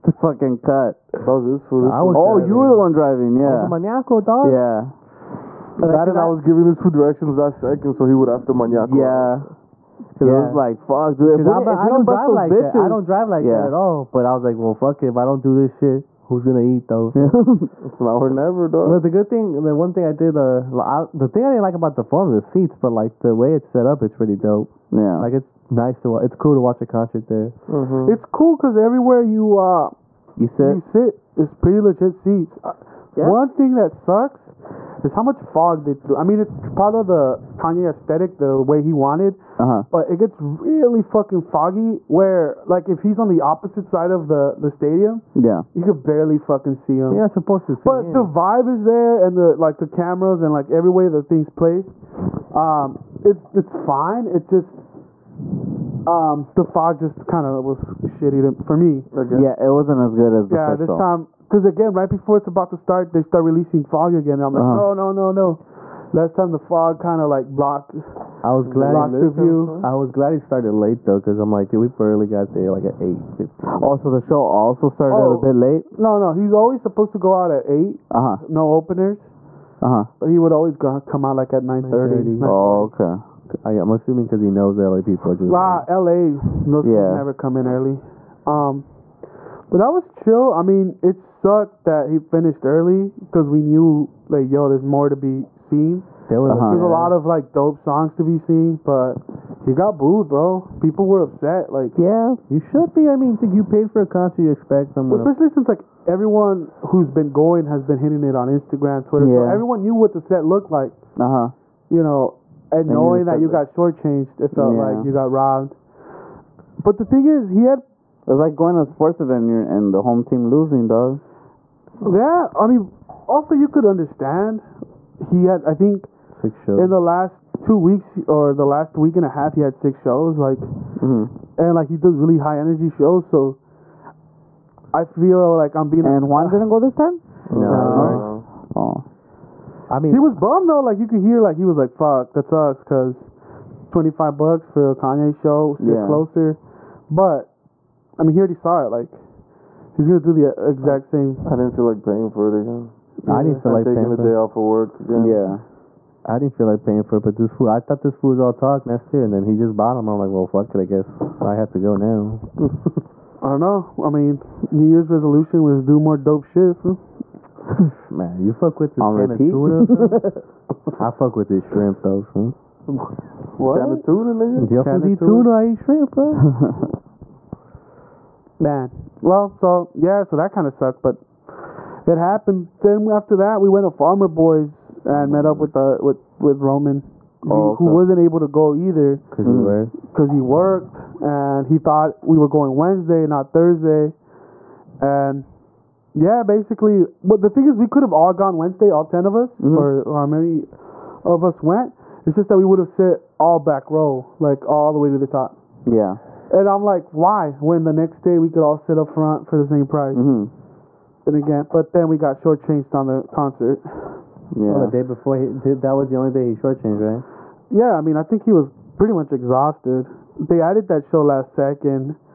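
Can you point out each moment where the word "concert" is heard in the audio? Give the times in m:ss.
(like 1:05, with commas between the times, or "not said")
0:26, 1:44, 3:33.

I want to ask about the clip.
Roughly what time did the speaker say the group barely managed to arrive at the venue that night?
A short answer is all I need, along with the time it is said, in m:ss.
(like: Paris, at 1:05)
8:15, at 1:13.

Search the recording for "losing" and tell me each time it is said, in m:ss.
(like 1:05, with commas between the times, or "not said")
2:00.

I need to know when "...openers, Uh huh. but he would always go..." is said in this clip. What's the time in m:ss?
1:18.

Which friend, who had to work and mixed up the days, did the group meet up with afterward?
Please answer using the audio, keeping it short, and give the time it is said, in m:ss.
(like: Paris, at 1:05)
Roman, at 3:06.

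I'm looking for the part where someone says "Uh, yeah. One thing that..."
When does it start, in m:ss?
0:32.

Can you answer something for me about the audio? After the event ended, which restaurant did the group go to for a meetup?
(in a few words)
Farmer Boys.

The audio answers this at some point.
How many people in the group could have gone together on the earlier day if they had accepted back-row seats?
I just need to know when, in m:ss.
3:19.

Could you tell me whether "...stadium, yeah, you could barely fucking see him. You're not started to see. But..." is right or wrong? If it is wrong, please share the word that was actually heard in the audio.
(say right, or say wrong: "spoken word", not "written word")
wrong: "supposed", not "started".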